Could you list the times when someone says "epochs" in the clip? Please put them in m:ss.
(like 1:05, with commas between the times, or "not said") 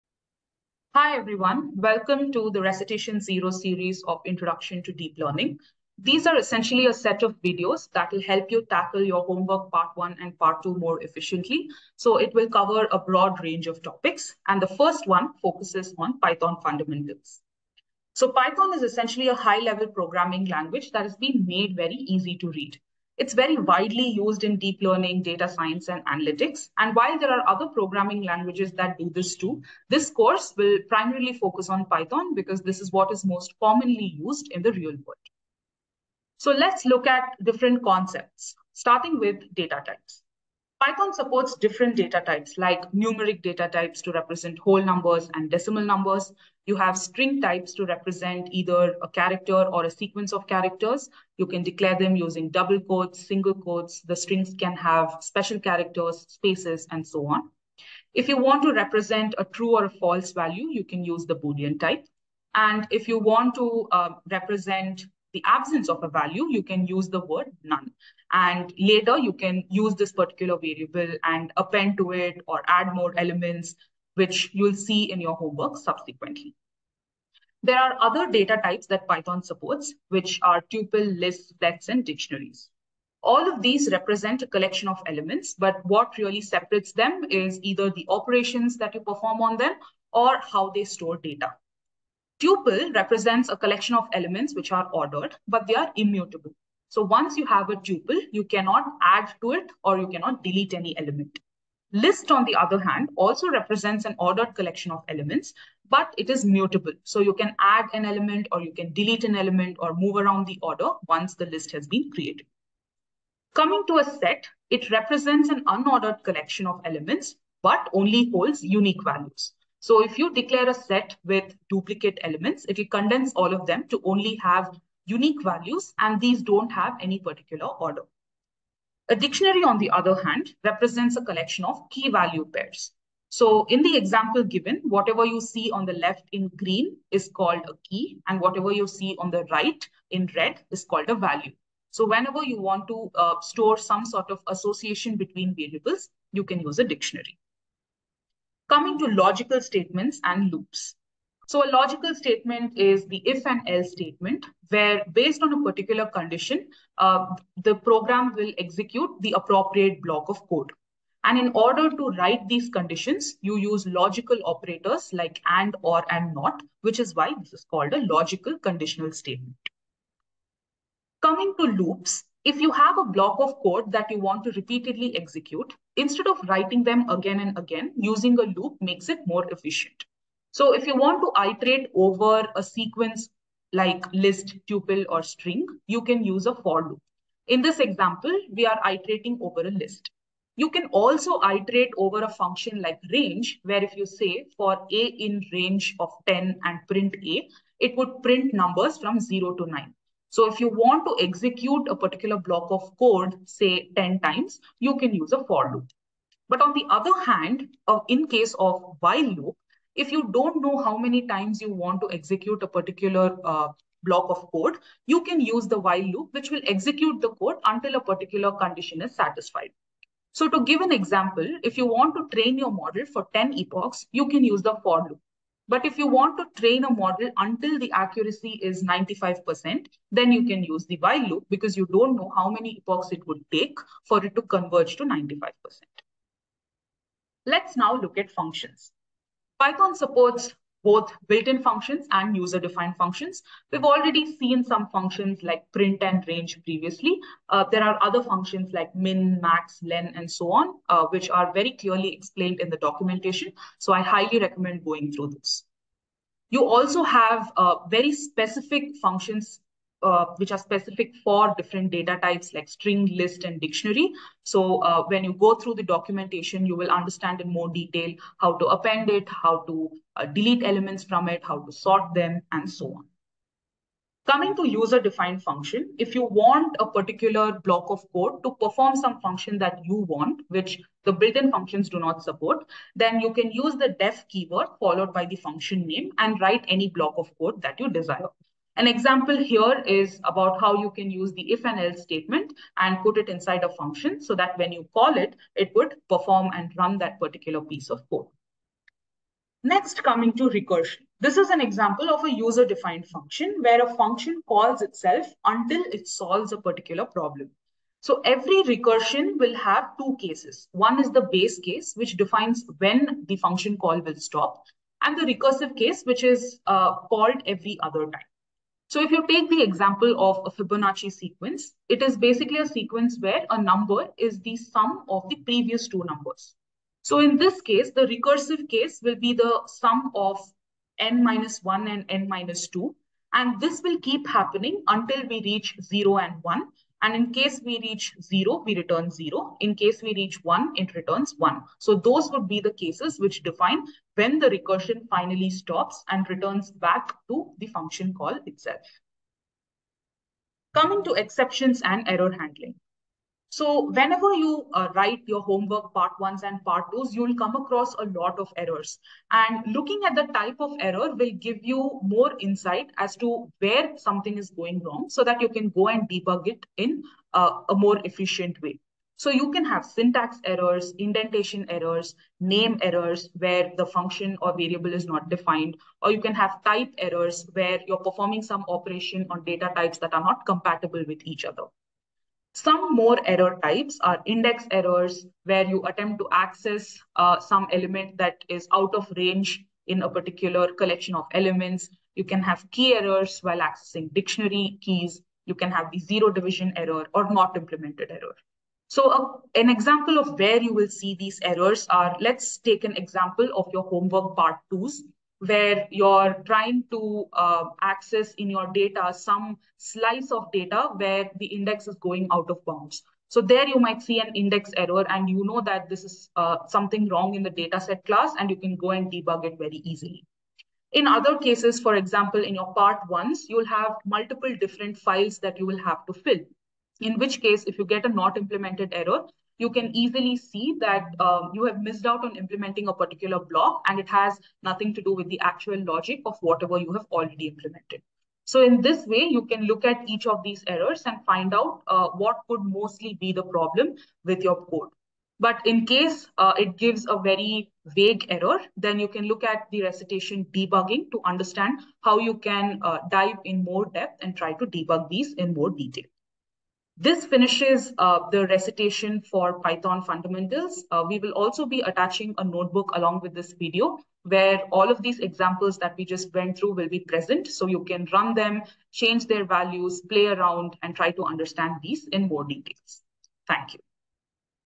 3:43, 3:52.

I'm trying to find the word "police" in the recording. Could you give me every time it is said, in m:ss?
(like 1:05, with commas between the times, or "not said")
not said.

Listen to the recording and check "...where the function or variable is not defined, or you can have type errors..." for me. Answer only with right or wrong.
right.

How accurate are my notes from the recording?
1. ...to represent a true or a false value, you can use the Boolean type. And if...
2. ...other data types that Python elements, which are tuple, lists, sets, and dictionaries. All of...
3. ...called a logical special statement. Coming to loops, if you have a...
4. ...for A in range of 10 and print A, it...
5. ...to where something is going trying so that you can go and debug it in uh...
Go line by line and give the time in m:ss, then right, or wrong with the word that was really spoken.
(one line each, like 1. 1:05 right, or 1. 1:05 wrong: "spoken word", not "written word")
1. 0:58 right
2. 1:18 wrong: "supports", not "elements"
3. 2:47 wrong: "conditional", not "special"
4. 3:14 right
5. 6:03 wrong: "wrong", not "trying".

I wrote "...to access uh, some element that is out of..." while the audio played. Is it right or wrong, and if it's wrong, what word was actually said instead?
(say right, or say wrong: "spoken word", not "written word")
right.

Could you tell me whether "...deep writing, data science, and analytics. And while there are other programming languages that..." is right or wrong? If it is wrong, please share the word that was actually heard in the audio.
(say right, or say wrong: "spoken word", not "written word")
wrong: "learning", not "writing".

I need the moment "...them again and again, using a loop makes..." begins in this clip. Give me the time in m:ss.
2:56.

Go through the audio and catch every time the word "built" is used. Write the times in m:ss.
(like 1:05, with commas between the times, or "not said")
4:01, 4:41.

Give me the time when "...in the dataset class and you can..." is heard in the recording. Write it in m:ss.
6:57.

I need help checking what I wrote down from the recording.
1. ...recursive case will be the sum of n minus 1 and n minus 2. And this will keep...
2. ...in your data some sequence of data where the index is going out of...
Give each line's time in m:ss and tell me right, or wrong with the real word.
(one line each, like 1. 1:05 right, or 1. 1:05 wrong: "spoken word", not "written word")
1. 5:28 right
2. 6:48 wrong: "slice", not "sequence".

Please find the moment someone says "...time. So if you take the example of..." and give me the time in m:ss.
5:18.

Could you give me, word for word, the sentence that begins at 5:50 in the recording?
Coming to exceptions and error handling.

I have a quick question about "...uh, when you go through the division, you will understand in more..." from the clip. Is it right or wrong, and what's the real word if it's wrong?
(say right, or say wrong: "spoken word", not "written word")
wrong: "documentation", not "division".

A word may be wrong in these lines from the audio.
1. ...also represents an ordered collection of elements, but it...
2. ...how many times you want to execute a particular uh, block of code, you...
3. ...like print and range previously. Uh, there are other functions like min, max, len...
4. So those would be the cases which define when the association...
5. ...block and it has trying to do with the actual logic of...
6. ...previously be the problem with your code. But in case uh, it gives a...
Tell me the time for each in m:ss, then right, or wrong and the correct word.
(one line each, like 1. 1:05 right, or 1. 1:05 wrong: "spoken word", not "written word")
1. 1:43 right
2. 3:30 right
3. 4:05 right
4. 5:41 wrong: "recursion", not "association"
5. 7:13 wrong: "nothing", not "trying"
6. 7:22 wrong: "mostly", not "previously".